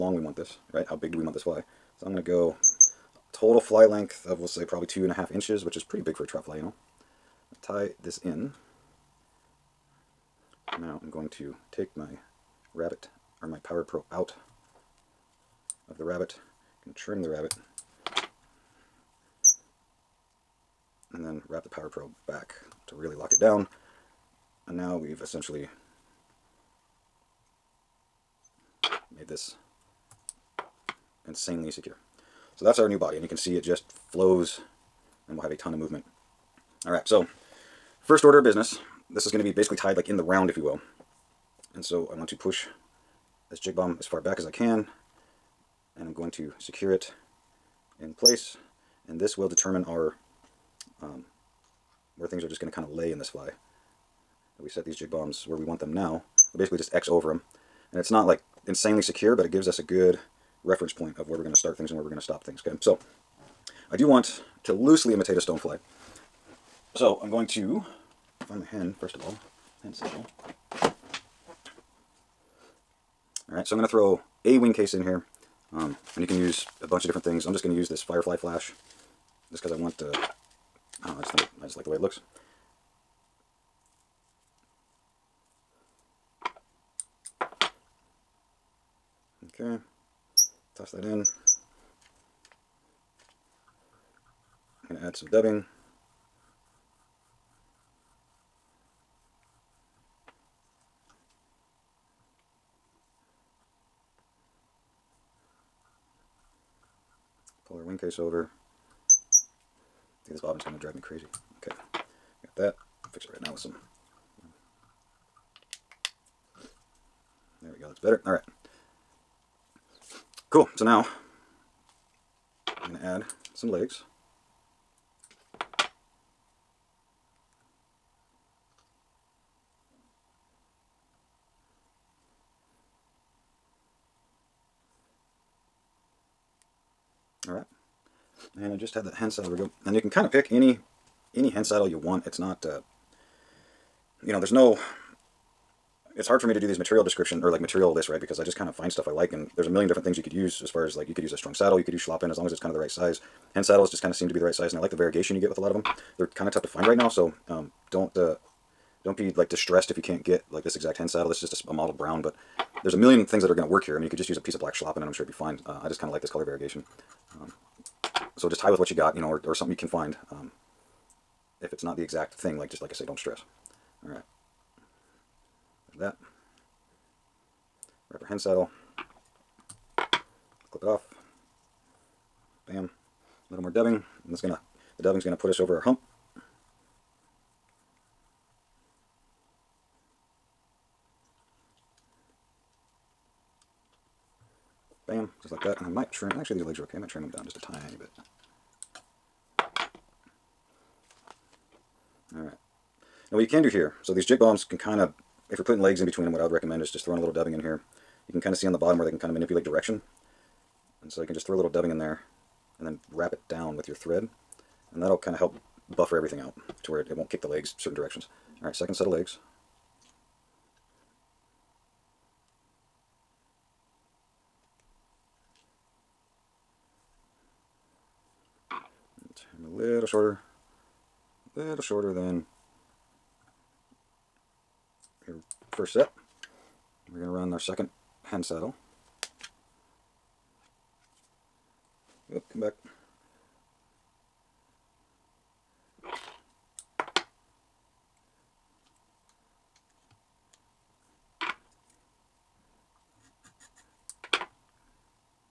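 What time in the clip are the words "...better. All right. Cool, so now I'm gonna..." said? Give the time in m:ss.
1:57.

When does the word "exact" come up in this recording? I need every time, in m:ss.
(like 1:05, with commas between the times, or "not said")
2:40, 2:52.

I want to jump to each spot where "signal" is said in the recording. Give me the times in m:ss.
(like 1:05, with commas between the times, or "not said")
1:09.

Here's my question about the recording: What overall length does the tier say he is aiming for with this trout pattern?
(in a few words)
2.5 inches.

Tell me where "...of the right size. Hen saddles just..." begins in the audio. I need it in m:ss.
2:32.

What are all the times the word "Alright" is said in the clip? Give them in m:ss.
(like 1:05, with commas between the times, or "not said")
0:36, 2:17, 3:38.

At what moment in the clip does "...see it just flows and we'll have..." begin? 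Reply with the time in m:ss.
0:33.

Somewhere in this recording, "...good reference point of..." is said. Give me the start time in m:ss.
0:59.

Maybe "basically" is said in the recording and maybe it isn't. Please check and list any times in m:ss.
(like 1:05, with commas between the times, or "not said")
0:39, 0:56.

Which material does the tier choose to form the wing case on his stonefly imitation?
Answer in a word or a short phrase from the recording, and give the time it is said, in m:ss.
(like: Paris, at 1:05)
Firefly Flash, at 1:18.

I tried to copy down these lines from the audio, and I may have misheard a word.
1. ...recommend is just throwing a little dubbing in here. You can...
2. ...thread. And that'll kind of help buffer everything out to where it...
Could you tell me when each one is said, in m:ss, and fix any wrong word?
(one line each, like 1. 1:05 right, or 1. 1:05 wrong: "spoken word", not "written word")
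1. 3:26 right
2. 3:33 right.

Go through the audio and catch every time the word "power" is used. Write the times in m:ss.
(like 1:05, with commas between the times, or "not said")
0:13, 0:21.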